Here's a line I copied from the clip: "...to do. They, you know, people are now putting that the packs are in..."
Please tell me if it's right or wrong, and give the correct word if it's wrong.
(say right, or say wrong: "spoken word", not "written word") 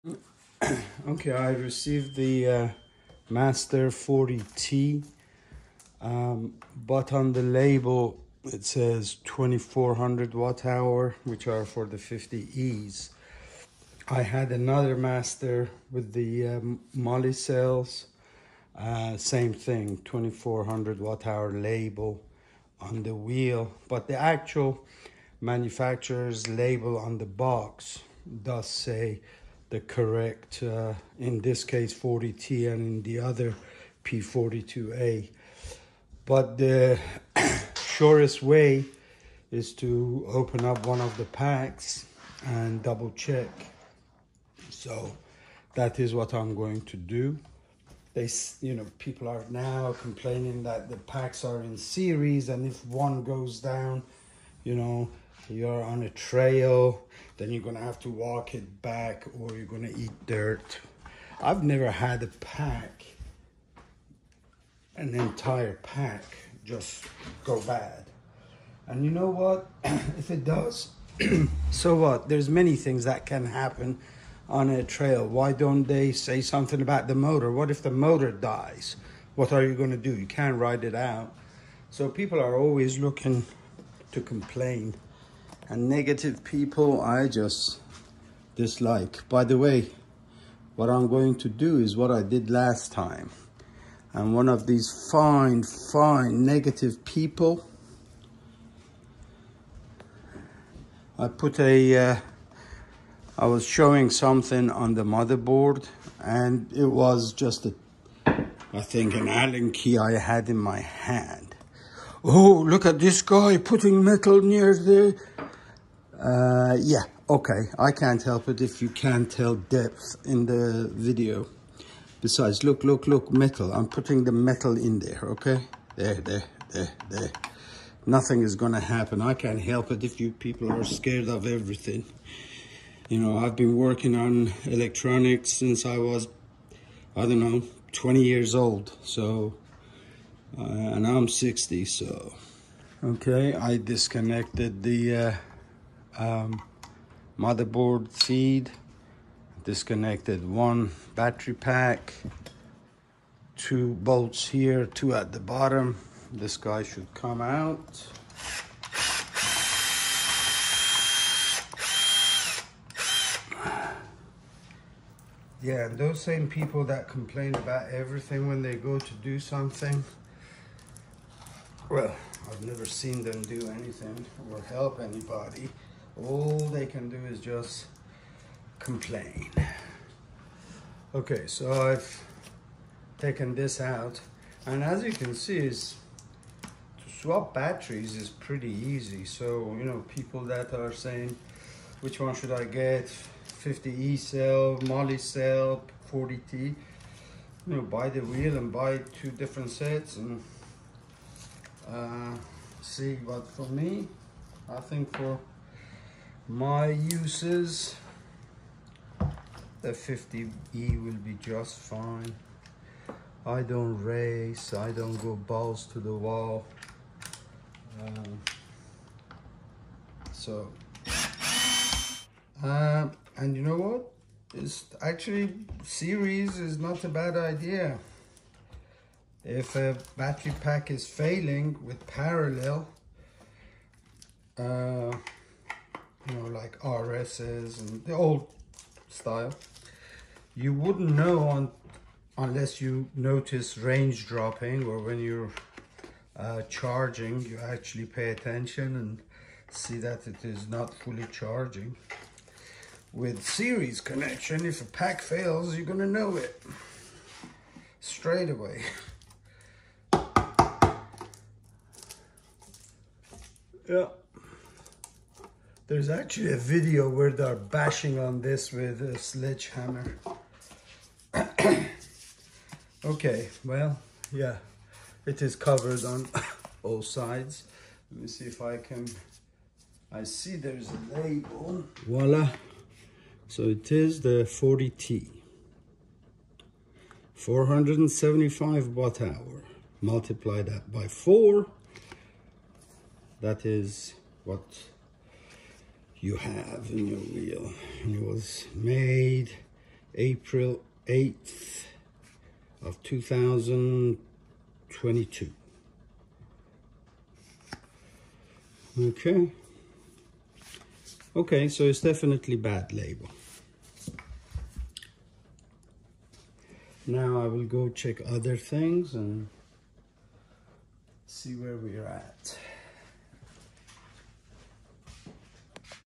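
wrong: "complaining", not "putting".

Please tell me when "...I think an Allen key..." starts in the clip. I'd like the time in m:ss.
1:48.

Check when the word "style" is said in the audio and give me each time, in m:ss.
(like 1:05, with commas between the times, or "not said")
3:59.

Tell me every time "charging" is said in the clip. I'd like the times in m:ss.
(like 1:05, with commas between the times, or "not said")
4:06, 4:11.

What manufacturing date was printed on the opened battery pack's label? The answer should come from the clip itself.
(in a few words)
April 8th, 2022.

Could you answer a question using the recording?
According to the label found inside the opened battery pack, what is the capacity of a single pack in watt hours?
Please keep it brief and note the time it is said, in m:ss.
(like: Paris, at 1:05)
475, at 4:47.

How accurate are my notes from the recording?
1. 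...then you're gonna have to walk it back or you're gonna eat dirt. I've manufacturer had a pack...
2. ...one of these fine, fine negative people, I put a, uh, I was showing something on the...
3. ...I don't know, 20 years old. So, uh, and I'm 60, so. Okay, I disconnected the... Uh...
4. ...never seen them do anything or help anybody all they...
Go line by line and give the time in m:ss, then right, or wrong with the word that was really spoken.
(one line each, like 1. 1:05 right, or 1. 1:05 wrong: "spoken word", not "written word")
1. 0:57 wrong: "never", not "manufacturer"
2. 1:34 right
3. 2:17 right
4. 2:52 right.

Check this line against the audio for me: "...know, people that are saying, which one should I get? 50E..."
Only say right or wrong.
right.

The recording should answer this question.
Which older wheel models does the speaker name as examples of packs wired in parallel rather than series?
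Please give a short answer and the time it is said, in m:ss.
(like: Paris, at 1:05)
RSs, at 3:56.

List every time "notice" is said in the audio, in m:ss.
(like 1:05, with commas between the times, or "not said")
4:03.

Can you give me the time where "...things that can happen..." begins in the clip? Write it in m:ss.
1:12.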